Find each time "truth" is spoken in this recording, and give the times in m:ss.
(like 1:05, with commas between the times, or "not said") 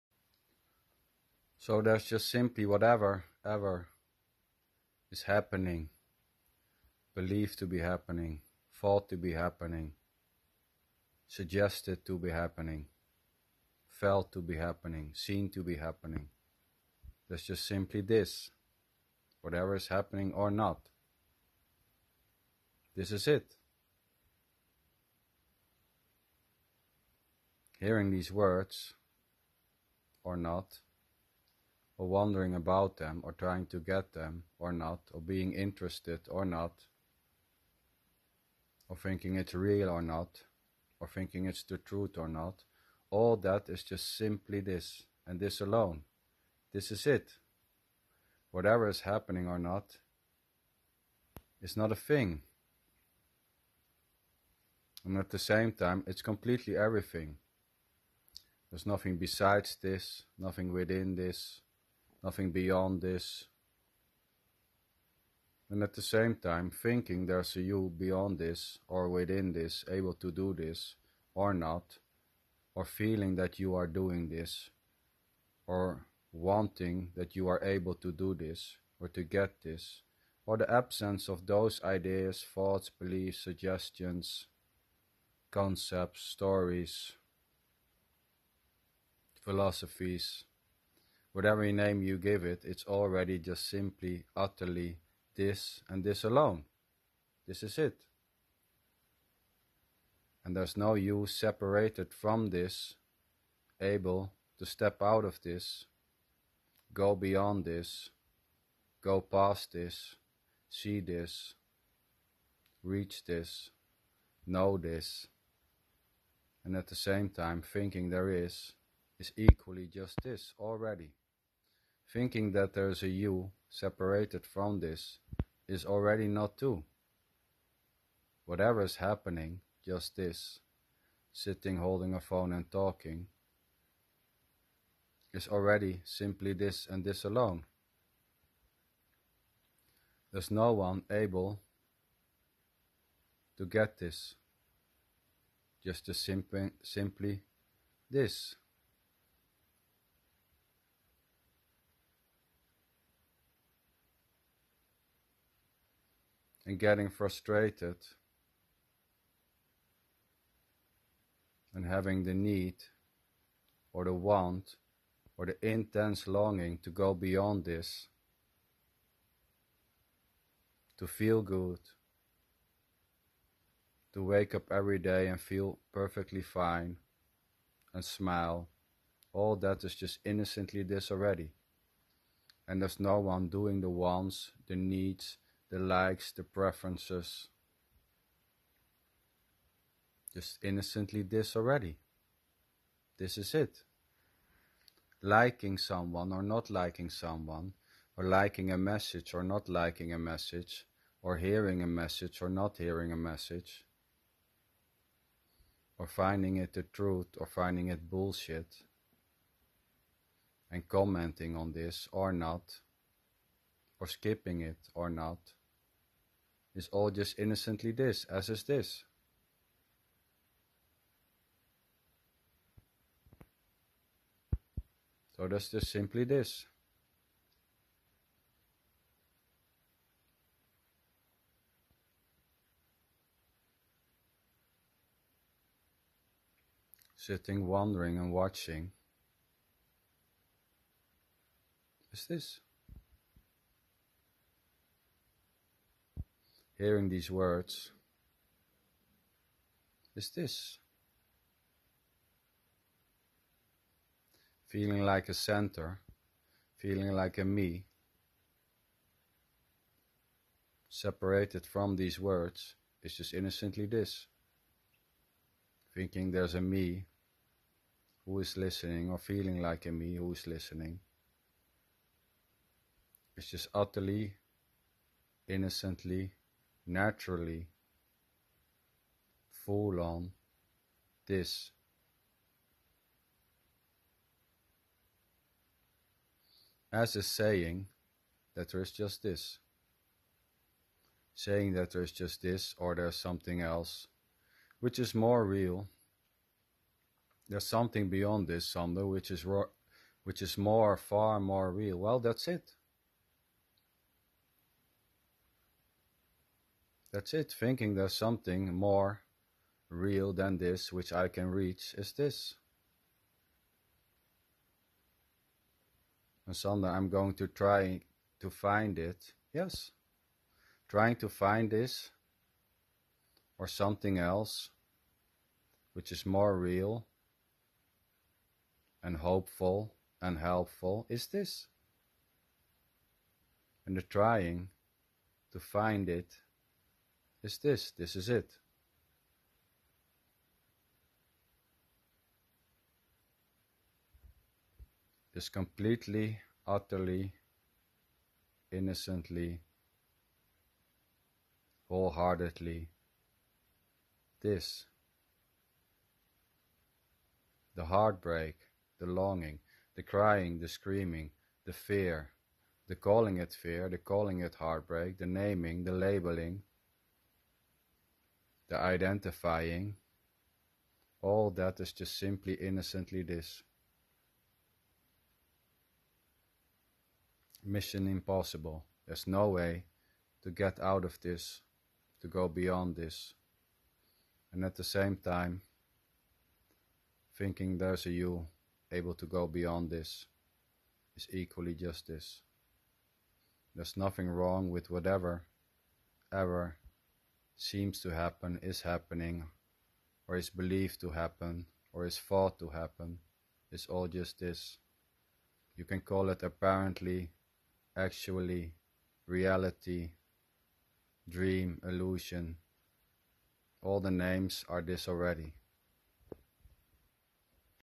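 0:41, 3:26.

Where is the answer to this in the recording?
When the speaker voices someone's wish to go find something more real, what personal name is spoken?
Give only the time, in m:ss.
5:16.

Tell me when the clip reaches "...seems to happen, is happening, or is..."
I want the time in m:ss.
6:37.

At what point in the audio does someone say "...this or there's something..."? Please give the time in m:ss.
4:52.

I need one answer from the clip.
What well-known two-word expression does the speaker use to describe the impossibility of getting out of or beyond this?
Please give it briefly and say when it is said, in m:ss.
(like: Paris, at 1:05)
Mission impossible, at 6:17.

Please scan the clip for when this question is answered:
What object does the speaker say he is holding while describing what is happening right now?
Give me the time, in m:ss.
2:12.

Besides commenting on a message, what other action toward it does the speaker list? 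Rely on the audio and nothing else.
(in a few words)
skipping it.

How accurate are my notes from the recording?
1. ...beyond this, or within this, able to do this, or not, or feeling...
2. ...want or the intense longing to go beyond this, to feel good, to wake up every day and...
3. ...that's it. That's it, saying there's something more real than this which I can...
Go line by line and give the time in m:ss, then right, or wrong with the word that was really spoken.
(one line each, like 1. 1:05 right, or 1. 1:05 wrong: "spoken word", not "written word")
1. 1:07 right
2. 2:44 right
3. 5:02 wrong: "thinking", not "saying".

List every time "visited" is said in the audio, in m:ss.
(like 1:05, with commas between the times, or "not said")
not said.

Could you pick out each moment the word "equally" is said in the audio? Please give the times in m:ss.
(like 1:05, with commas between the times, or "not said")
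1:59, 6:31.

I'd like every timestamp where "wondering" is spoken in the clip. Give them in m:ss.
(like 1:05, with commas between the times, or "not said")
0:32, 3:57.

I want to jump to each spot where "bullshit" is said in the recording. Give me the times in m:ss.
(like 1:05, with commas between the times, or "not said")
3:28.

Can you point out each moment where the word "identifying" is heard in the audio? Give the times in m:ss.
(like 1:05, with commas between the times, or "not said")
6:08.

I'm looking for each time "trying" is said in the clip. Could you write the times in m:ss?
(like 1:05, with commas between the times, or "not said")
0:33, 5:20, 5:34.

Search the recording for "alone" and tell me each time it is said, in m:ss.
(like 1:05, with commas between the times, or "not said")
0:45, 1:36, 2:17.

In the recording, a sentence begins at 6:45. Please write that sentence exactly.
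You can call it apparently, actually, reality, dream, illusion.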